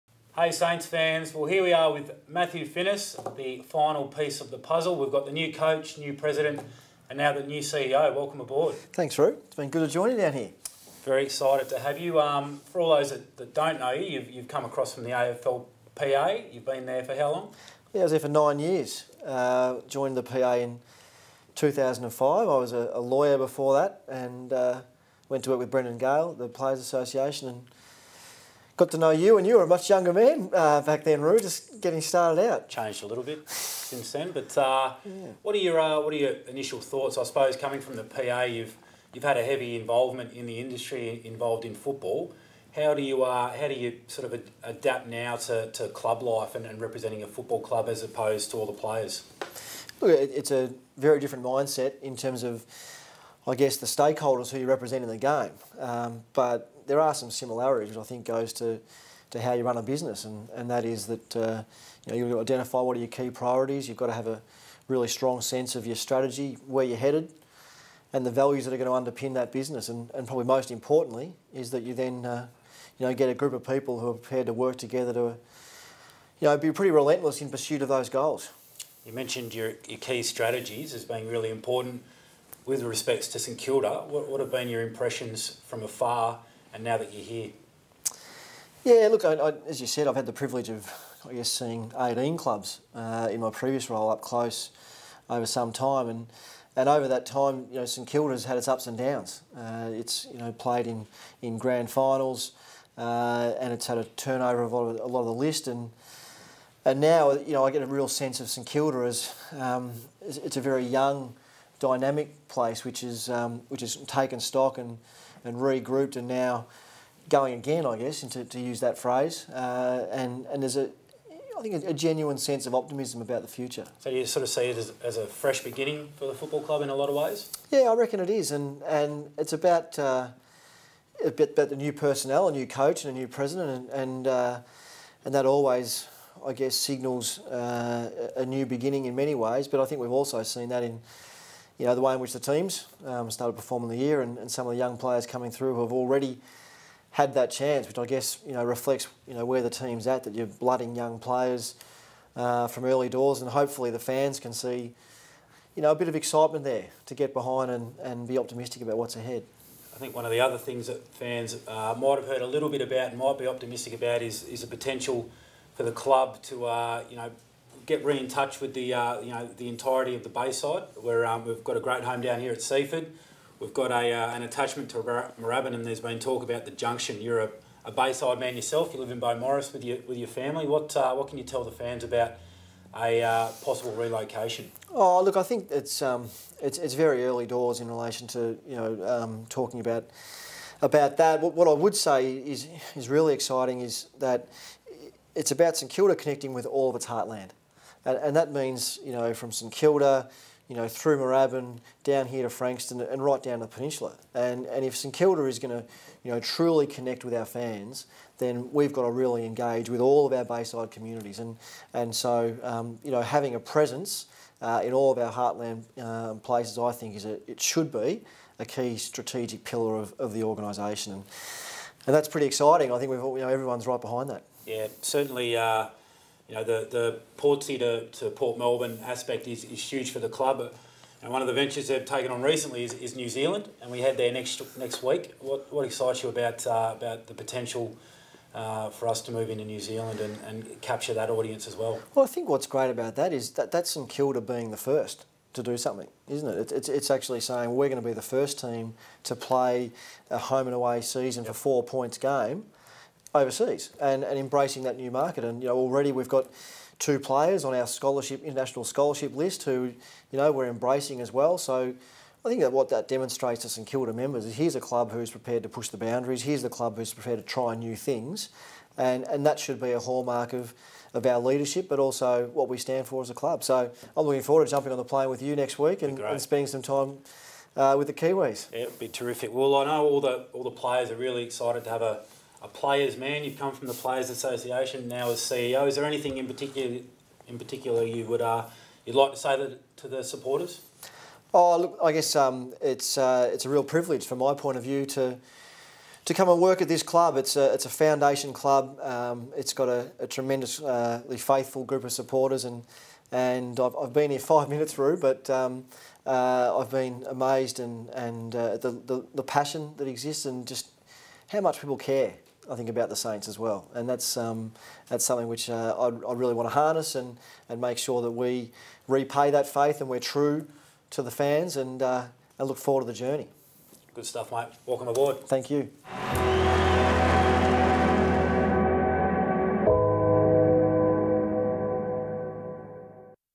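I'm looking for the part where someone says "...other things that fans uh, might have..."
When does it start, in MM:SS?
02:40.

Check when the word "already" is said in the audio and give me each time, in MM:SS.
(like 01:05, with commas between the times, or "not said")
02:25, 04:15.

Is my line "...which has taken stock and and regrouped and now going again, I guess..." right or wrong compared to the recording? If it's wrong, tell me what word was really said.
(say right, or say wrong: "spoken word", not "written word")
right.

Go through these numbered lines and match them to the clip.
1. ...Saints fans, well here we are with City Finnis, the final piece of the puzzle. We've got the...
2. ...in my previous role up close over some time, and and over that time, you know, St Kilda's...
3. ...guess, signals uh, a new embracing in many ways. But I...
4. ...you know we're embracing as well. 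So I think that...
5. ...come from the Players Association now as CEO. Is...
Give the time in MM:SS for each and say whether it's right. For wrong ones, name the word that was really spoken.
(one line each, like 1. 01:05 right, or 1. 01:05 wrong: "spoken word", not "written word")
1. 00:00 wrong: "Matthew", not "City"
2. 01:33 right
3. 02:16 wrong: "beginning", not "embracing"
4. 04:20 right
5. 04:43 right.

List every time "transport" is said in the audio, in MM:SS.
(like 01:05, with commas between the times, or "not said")
not said.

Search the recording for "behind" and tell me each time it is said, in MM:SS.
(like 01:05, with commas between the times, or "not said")
02:37, 03:44.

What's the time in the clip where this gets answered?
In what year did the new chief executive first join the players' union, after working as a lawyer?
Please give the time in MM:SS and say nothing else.
00:21.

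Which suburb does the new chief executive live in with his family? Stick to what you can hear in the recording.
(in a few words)
Beaumaris.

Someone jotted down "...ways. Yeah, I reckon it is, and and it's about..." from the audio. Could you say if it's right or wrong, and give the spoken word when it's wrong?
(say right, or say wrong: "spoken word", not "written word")
right.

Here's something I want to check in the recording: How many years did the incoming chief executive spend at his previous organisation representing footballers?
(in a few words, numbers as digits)
9.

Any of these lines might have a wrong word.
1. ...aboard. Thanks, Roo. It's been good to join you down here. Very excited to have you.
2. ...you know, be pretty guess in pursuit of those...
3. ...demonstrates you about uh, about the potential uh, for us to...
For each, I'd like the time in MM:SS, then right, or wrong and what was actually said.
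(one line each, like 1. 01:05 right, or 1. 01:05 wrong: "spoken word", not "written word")
1. 00:08 right
2. 01:15 wrong: "relentless", not "guess"
3. 03:55 wrong: "excites", not "demonstrates".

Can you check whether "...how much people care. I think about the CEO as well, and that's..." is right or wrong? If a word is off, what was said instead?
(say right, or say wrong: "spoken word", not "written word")
wrong: "Saints", not "CEO".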